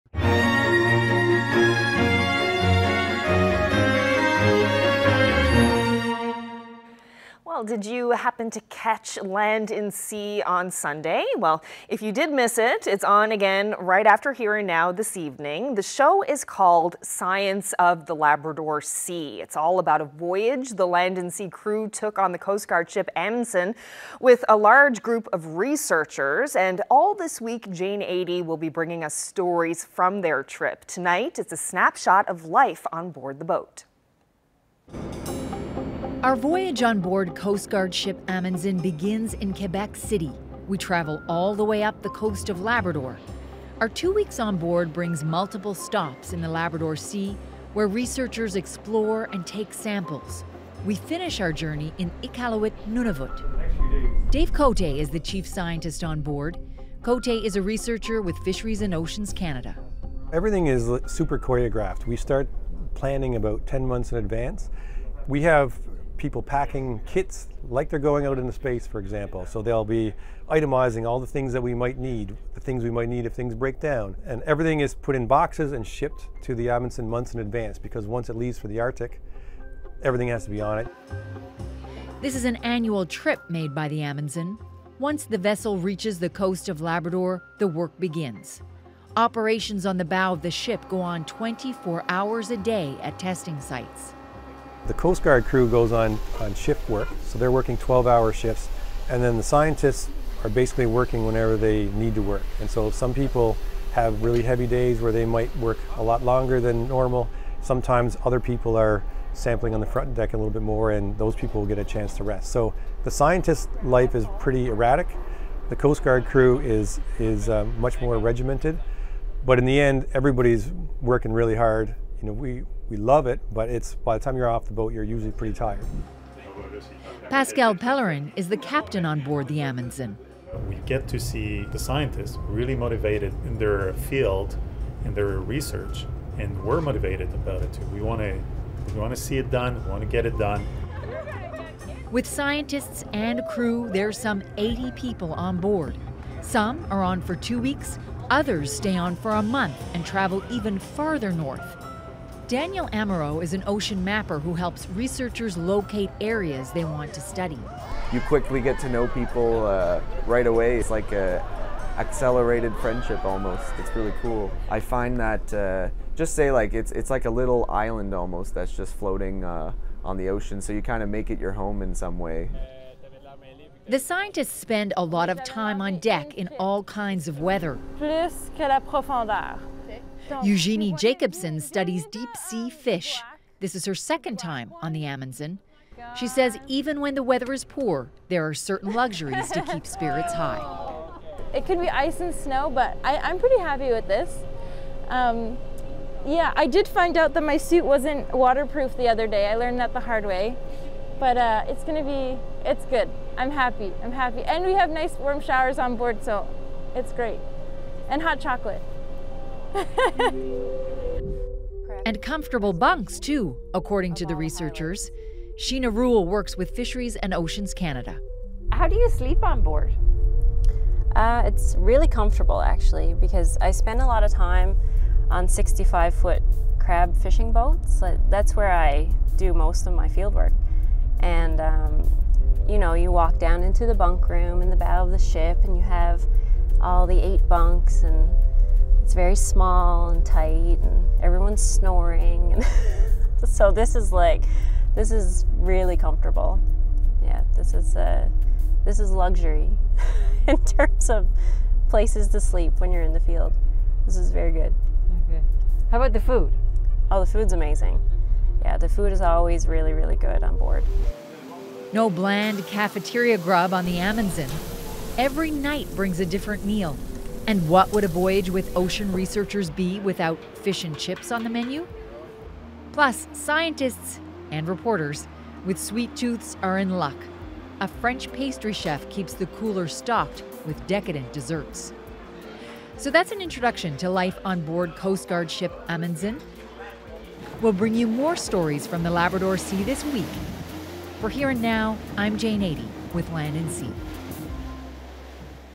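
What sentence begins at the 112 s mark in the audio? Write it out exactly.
So the scientist life is pretty erratic.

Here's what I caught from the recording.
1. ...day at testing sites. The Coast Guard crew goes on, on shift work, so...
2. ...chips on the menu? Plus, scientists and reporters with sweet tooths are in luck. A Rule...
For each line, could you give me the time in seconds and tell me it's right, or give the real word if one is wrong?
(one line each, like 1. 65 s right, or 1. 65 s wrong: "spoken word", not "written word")
1. 92 s right
2. 270 s wrong: "French", not "Rule".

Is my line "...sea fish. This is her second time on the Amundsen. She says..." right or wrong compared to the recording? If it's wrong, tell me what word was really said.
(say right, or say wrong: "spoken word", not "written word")
right.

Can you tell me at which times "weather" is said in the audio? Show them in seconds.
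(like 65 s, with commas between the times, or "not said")
177 s, 187 s.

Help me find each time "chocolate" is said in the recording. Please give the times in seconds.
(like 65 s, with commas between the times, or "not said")
208 s.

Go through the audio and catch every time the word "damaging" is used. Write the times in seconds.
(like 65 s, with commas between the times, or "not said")
not said.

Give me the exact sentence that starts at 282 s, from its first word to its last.
So that's an introduction to life on board Coast Guard ship Amundsen.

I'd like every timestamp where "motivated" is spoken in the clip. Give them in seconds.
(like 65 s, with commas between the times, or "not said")
132 s, 136 s.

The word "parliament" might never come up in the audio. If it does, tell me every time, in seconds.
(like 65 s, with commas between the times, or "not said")
not said.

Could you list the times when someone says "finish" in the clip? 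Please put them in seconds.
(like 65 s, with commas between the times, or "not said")
50 s.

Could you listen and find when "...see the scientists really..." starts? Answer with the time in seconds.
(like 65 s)
131 s.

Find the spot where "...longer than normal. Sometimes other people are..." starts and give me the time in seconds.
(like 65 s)
106 s.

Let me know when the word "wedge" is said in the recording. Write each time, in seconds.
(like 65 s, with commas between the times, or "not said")
not said.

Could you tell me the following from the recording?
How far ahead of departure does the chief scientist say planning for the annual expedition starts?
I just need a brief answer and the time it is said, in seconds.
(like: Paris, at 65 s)
10 months, at 63 s.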